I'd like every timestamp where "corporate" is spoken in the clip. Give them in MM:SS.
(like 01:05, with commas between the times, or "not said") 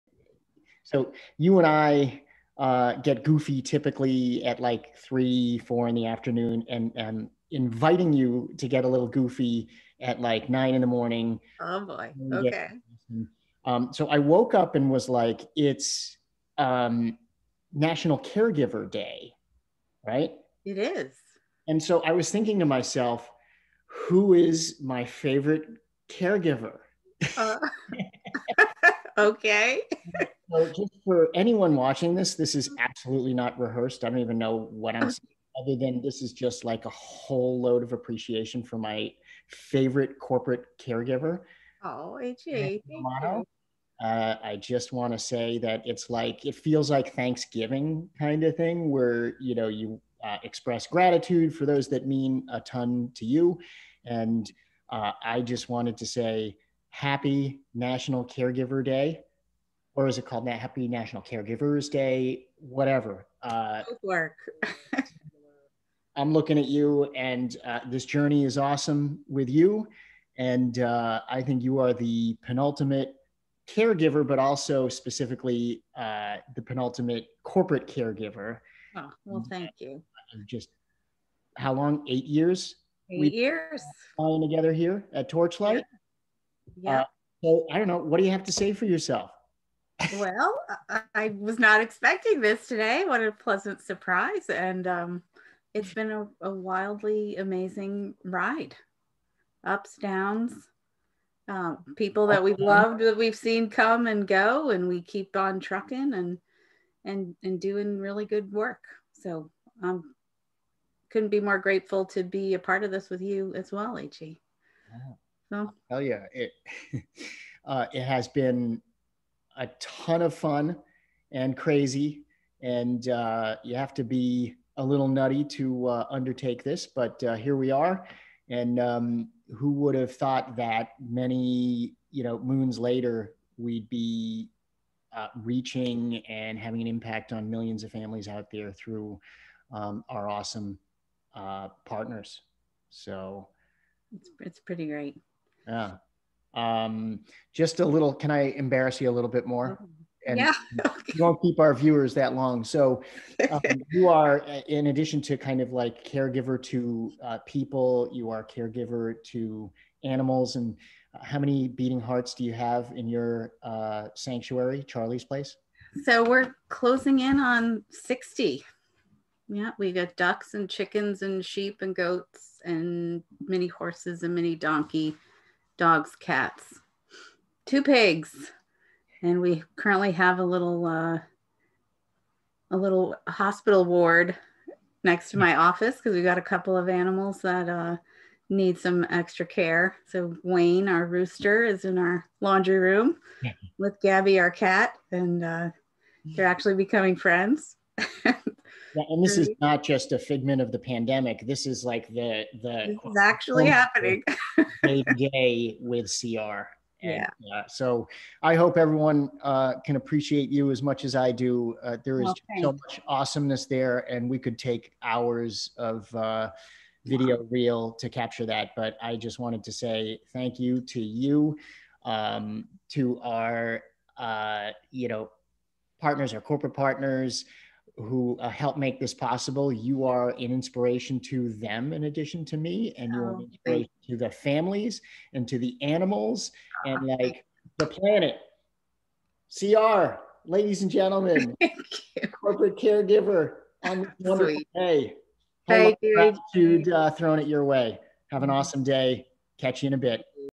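00:40, 01:17, 03:46, 04:02.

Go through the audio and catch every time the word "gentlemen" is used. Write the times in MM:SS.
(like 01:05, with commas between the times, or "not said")
04:00.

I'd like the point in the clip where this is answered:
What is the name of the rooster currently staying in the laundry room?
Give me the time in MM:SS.
03:10.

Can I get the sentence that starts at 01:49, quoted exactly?
So I um, couldn't be more grateful to be a part of this with you as well, H.E.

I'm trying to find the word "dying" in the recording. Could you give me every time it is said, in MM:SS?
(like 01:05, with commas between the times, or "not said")
not said.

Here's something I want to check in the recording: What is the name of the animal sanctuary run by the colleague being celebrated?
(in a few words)
Charlie's Place.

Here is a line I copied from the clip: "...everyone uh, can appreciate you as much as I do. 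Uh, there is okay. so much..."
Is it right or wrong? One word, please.
right.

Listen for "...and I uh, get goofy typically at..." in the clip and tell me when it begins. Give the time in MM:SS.
00:01.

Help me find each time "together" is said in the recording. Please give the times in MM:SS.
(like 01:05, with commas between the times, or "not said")
01:24.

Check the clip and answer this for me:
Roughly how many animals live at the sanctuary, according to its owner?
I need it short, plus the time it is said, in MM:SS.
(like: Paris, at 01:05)
60, at 02:47.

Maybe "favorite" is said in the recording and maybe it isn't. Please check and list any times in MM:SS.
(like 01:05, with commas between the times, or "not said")
00:25, 00:39.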